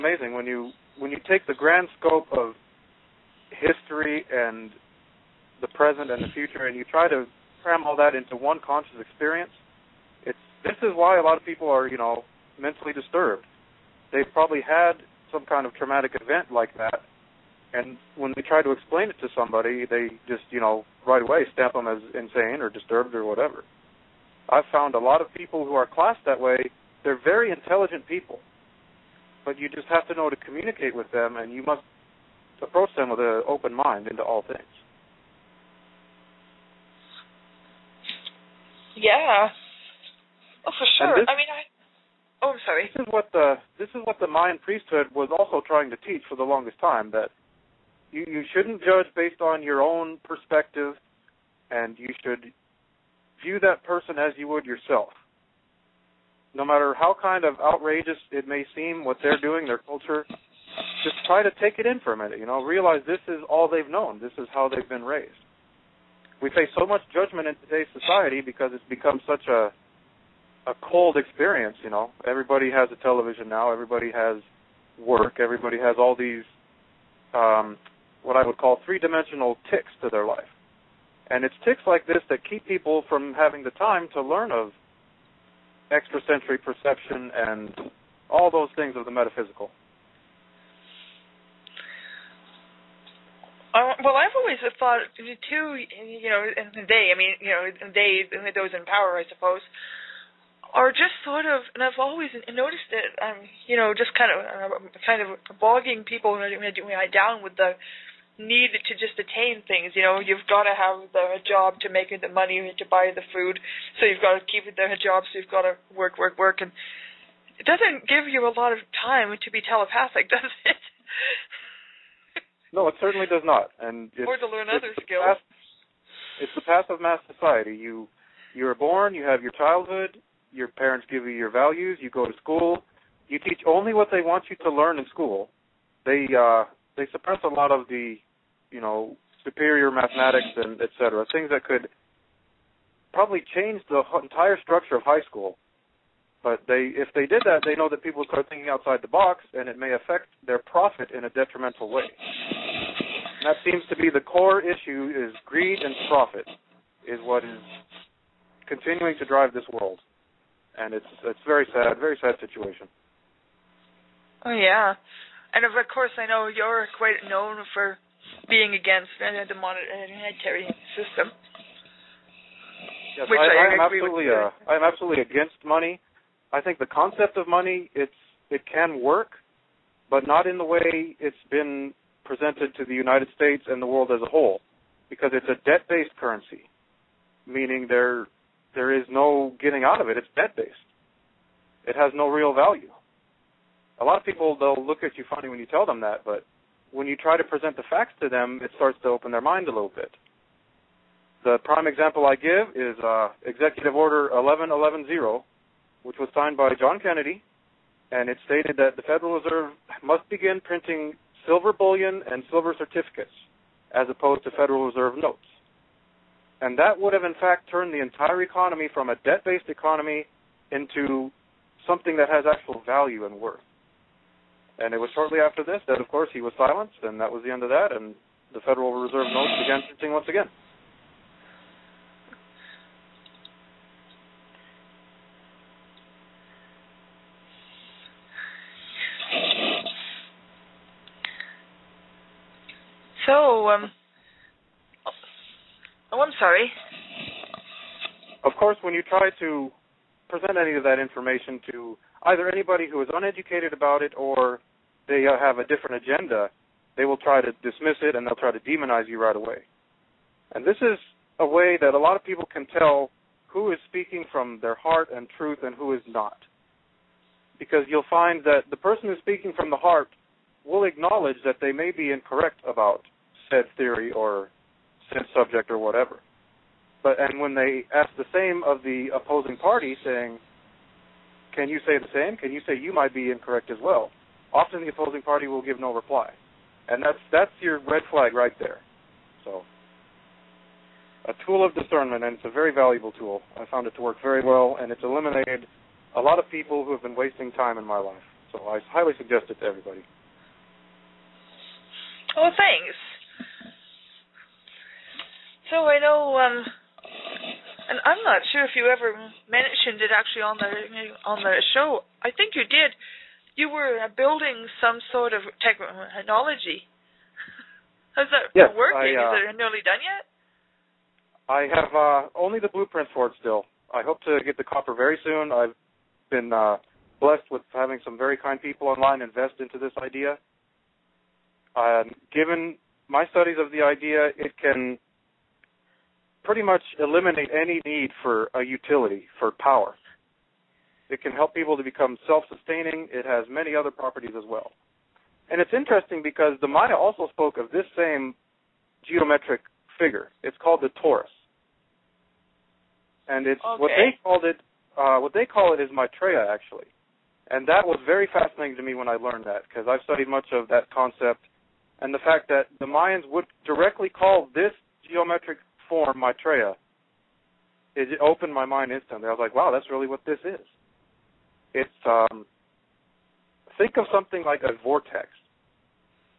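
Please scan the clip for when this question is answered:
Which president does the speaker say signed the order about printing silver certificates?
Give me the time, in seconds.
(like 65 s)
206 s.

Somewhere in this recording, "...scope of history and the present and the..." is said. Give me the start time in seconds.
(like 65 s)
1 s.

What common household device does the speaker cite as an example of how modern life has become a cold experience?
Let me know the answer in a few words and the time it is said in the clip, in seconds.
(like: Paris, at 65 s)
television, at 73 s.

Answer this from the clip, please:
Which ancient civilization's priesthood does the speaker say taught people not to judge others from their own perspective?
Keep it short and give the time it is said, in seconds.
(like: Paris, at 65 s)
Mayan, at 44 s.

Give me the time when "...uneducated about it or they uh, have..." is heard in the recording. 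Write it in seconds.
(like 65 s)
253 s.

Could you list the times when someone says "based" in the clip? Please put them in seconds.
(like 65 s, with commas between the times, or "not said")
49 s, 185 s, 190 s, 219 s.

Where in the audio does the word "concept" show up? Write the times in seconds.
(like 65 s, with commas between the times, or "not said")
176 s, 360 s.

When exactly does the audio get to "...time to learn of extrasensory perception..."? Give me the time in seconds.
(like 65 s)
83 s.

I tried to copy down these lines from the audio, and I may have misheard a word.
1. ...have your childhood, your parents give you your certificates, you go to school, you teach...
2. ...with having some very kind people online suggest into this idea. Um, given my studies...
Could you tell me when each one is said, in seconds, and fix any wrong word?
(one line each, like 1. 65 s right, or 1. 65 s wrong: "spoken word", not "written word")
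1. 129 s wrong: "values", not "certificates"
2. 327 s wrong: "invest", not "suggest".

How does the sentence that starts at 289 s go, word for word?
So, a tool of discernment, and it's a very valuable tool.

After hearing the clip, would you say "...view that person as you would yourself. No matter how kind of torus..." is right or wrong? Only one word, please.
wrong.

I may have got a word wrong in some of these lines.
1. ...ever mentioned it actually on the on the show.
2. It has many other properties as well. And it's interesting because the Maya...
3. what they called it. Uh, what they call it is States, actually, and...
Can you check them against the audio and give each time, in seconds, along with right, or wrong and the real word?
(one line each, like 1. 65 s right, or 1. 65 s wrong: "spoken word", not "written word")
1. 308 s right
2. 343 s right
3. 353 s wrong: "Maitreya", not "States".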